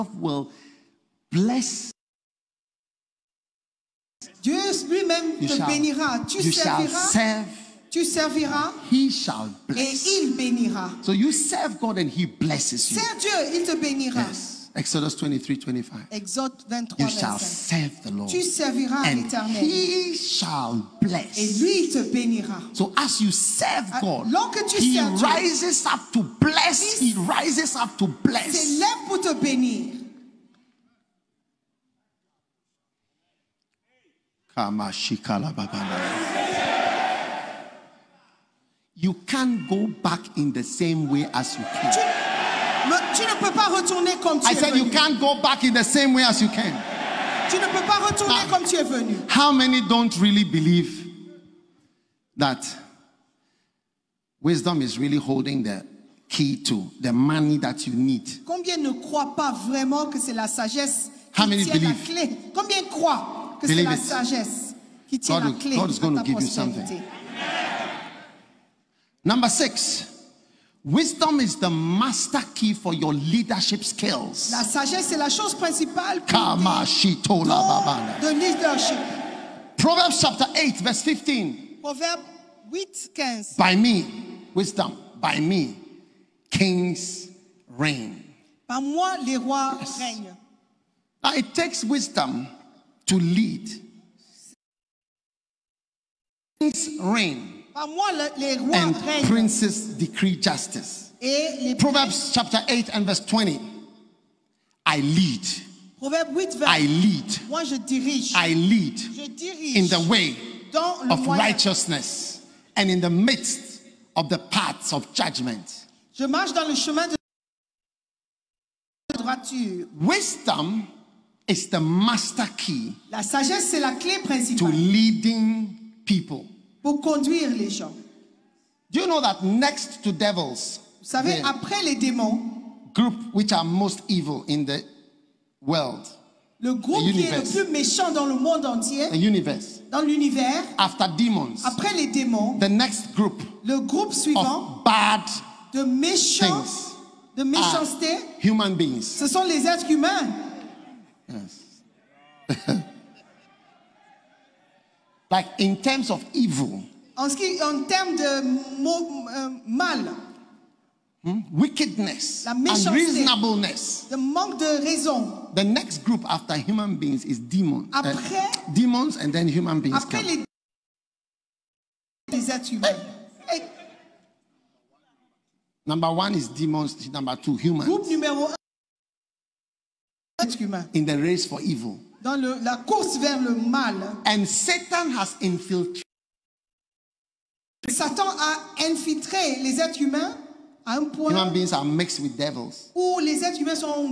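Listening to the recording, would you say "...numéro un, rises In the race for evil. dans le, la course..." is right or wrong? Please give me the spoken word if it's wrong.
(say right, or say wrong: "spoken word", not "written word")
wrong: "êtres", not "rises".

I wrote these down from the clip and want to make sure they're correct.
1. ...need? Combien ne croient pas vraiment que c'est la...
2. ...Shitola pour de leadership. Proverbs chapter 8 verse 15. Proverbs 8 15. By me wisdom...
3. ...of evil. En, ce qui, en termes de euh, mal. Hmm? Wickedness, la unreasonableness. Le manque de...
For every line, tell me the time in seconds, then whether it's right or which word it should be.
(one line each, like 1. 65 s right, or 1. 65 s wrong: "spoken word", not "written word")
1. 57 s right
2. 76 s right
3. 156 s right.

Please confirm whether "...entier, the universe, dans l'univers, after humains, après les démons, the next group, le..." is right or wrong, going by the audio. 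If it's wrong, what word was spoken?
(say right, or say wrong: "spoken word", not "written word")
wrong: "demons", not "humains".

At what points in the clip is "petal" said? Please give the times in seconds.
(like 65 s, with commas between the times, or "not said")
not said.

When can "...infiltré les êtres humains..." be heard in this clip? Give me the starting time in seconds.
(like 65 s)
188 s.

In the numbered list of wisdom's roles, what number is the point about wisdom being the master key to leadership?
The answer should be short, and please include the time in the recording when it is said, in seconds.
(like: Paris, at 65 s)
6, at 69 s.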